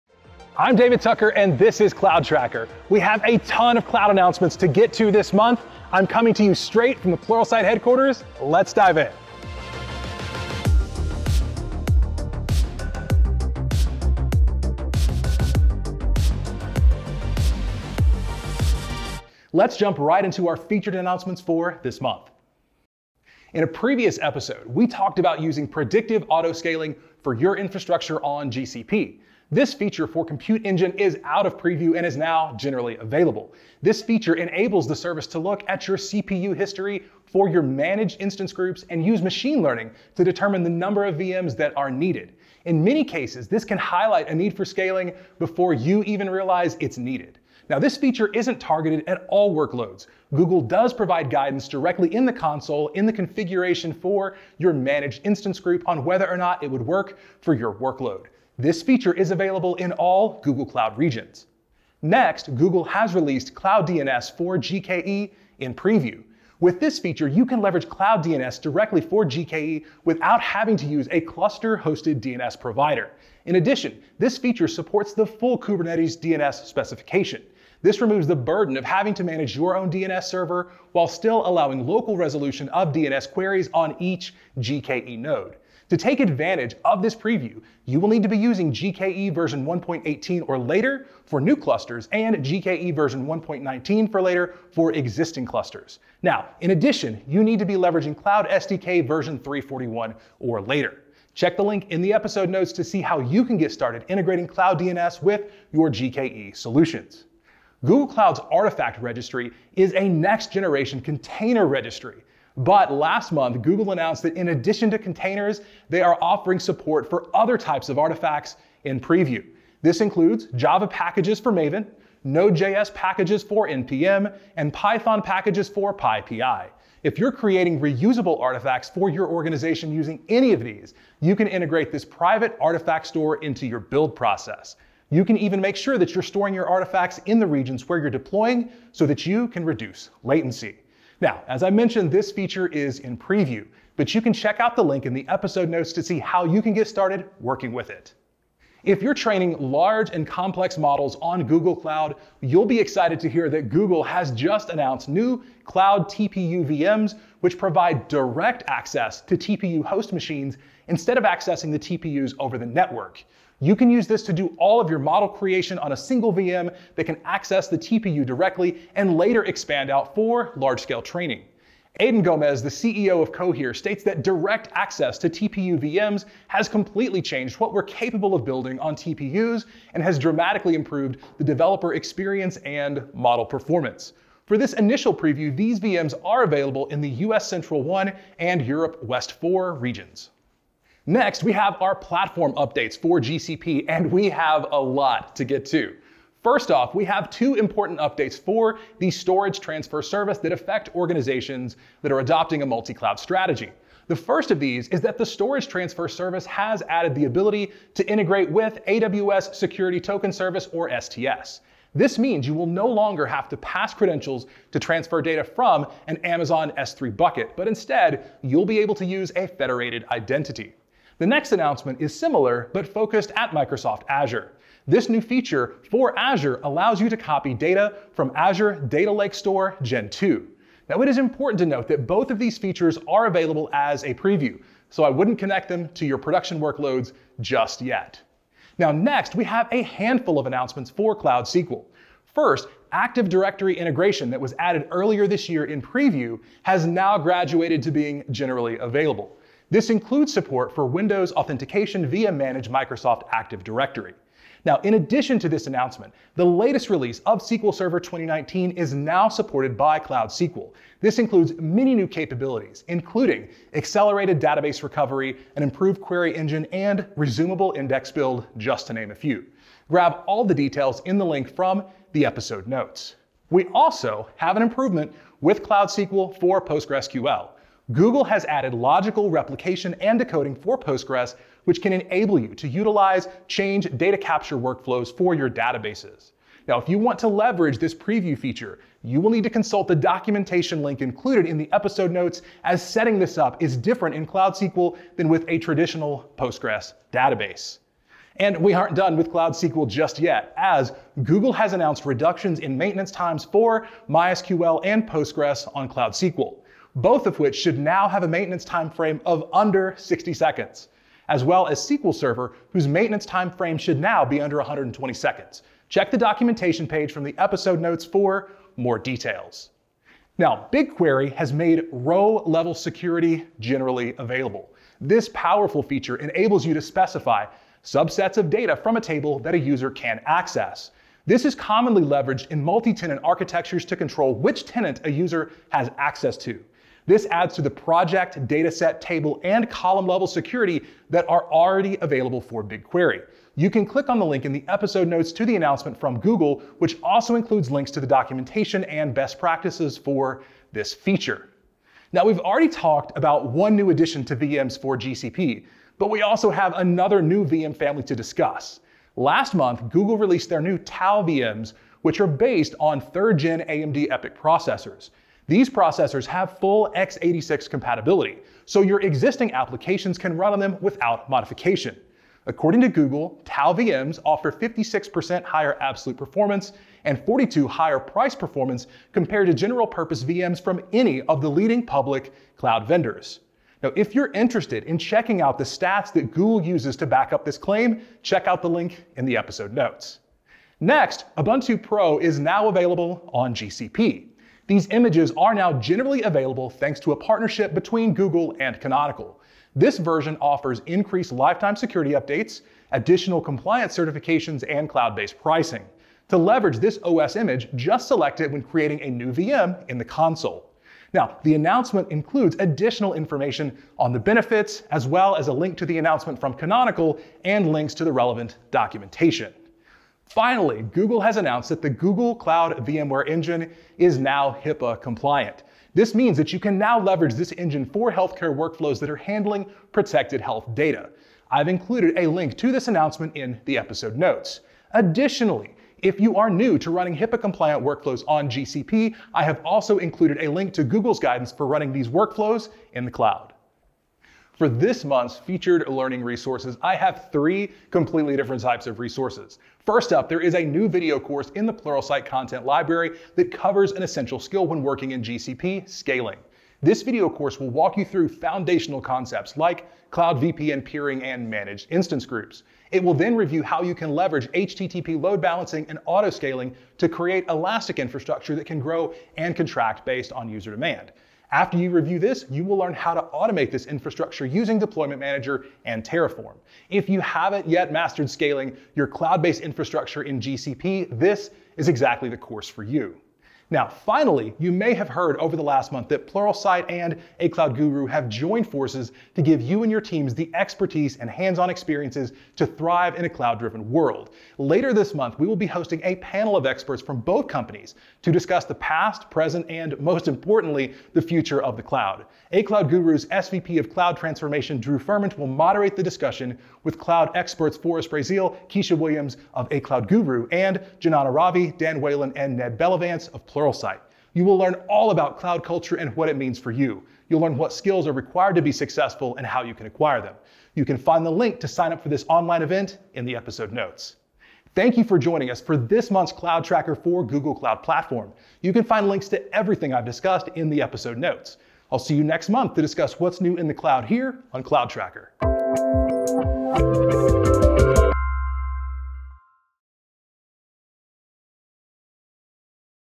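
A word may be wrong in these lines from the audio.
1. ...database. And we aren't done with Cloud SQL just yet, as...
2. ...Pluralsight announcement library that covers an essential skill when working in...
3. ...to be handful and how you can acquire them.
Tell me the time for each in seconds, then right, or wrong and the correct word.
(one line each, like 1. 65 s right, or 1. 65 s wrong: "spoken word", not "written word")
1. 297 s right
2. 451 s wrong: "content", not "announcement"
3. 518 s wrong: "successful", not "handful".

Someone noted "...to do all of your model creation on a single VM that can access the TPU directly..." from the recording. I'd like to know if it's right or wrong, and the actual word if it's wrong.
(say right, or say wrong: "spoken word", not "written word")
right.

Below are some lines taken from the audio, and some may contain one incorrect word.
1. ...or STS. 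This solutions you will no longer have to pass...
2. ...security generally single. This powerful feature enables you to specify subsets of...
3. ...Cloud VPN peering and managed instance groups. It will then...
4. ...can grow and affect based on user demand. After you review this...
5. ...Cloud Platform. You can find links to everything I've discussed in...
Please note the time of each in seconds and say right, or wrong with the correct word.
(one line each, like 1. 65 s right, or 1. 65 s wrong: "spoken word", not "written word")
1. 210 s wrong: "means", not "solutions"
2. 322 s wrong: "available", not "single"
3. 460 s right
4. 468 s wrong: "contract", not "affect"
5. 527 s right.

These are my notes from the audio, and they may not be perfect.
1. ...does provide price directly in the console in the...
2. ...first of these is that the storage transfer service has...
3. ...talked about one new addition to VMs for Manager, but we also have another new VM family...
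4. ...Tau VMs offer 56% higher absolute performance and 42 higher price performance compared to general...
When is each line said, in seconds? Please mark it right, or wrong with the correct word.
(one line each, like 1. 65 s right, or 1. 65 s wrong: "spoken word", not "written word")
1. 50 s wrong: "guidance", not "price"
2. 204 s right
3. 352 s wrong: "GCP", not "Manager"
4. 373 s right.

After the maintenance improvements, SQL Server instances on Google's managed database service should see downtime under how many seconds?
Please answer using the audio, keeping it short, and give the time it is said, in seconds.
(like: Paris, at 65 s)
120, at 314 s.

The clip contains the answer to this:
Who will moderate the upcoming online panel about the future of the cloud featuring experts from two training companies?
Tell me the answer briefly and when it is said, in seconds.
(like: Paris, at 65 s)
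Drew Firment, at 504 s.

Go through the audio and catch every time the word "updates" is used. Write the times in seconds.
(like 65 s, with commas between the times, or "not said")
192 s, 197 s, 402 s.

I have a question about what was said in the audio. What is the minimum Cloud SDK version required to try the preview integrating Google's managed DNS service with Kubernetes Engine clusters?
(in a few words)
341.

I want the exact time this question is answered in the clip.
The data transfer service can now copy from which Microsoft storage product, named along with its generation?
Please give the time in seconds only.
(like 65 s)
228 s.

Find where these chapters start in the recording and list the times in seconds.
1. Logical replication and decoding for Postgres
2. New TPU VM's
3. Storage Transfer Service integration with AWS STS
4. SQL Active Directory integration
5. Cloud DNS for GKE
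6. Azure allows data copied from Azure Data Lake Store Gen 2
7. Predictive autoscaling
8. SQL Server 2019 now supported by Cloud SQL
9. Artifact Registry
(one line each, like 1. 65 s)
1. 273 s
2. 148 s
3. 190 s
4. 238 s
5. 61 s
6. 220 s
7. 19 s
8. 255 s
9. 107 s.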